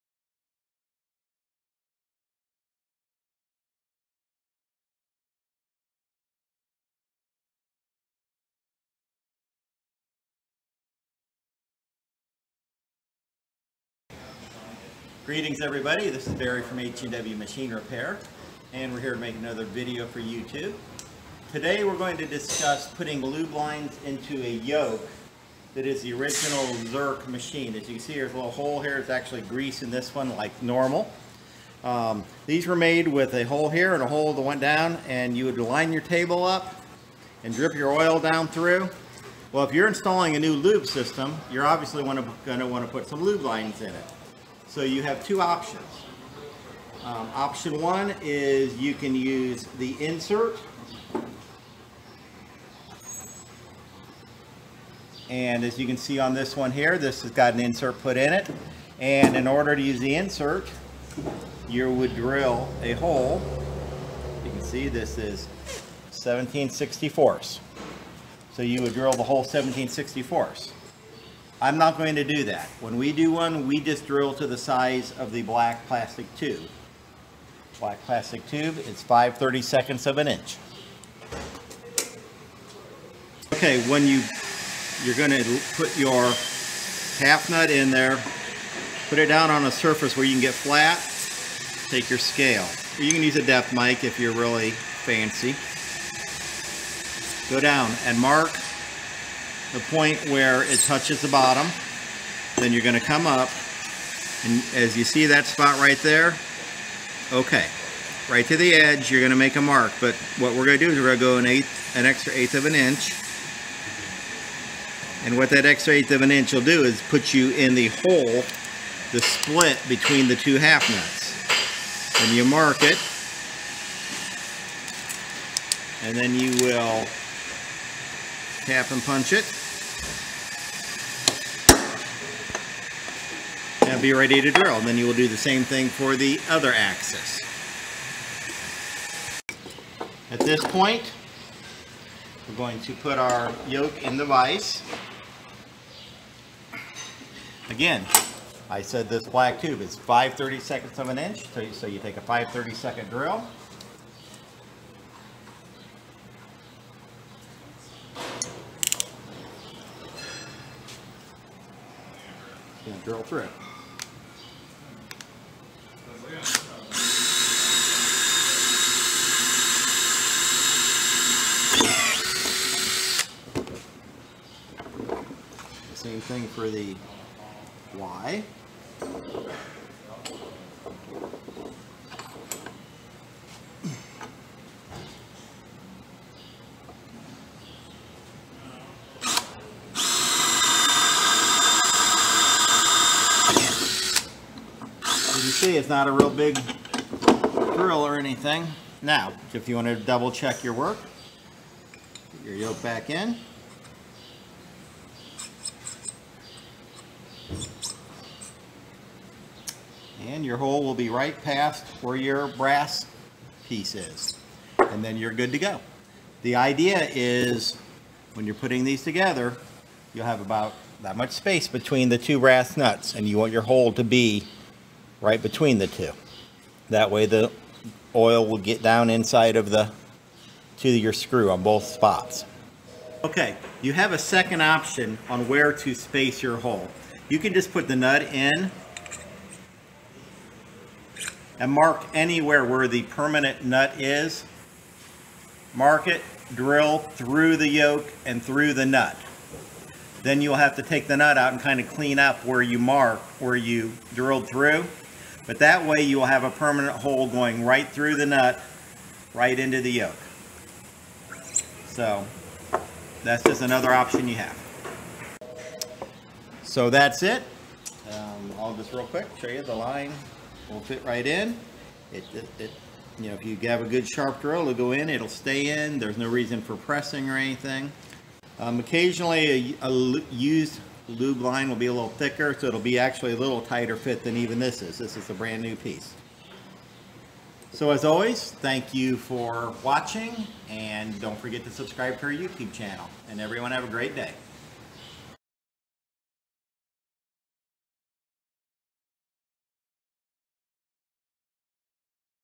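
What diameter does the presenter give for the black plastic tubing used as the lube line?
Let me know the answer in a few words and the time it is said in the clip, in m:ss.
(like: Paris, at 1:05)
5/32 of an inch, at 2:29.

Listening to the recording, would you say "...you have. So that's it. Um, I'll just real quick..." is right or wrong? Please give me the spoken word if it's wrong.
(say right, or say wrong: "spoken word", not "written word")
right.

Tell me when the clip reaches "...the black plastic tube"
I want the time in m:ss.
1:15.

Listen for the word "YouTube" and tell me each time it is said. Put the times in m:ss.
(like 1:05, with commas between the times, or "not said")
0:20, 4:52.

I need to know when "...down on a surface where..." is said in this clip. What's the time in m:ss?
1:29.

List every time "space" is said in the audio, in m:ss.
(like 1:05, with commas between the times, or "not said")
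3:41, 3:55.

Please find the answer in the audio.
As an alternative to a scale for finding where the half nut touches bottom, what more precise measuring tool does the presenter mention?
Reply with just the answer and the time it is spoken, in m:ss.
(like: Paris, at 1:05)
depth mic, at 1:33.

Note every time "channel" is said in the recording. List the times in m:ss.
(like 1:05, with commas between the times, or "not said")
4:52.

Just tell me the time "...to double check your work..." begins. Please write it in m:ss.
3:19.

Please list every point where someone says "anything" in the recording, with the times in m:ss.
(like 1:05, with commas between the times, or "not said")
3:18, 4:37.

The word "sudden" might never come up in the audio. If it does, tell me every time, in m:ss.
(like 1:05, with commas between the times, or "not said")
not said.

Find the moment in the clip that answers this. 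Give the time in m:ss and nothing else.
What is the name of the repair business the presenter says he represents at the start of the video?
0:16.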